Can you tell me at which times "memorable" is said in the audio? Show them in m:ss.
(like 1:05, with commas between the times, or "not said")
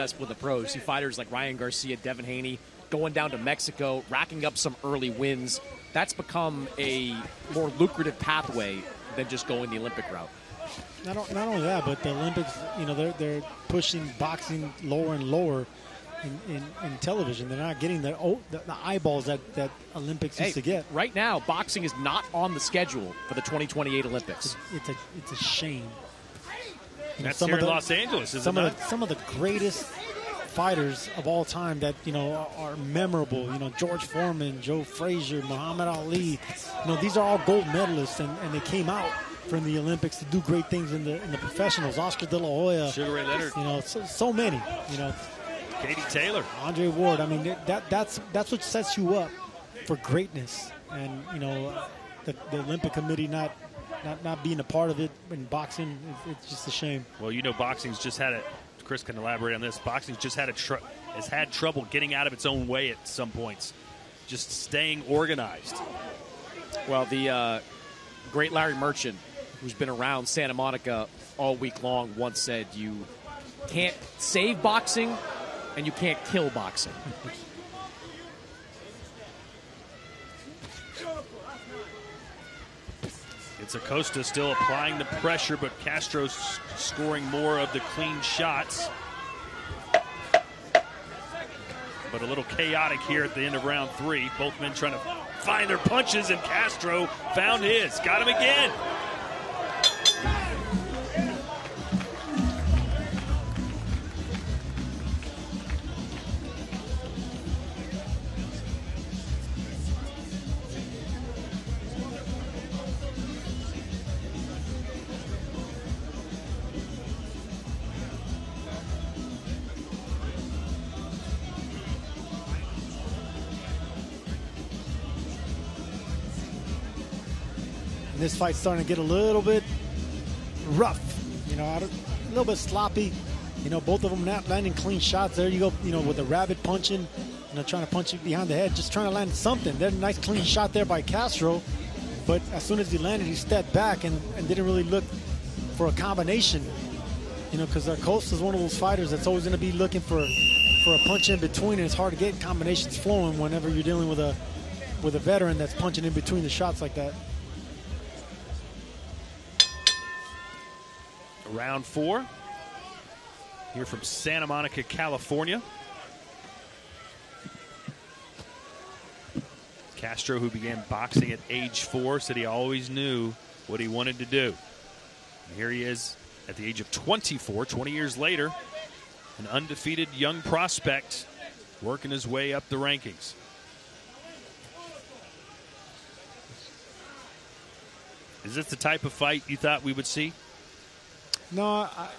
0:32.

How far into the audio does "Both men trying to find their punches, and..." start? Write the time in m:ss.
1:34.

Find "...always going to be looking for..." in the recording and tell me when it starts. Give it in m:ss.
2:29.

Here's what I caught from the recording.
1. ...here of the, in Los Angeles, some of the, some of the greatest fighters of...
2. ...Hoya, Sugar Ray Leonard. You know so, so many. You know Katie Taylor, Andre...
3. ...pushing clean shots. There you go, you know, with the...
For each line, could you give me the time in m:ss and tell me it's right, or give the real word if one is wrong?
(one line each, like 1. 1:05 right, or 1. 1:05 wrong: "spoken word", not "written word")
1. 0:27 right
2. 0:42 right
3. 2:14 wrong: "landing", not "pushing".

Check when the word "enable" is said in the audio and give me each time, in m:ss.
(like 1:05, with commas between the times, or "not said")
not said.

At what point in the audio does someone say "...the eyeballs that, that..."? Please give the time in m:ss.
0:18.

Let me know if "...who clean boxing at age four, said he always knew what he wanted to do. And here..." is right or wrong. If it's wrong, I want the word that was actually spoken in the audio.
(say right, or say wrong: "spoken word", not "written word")
wrong: "began", not "clean".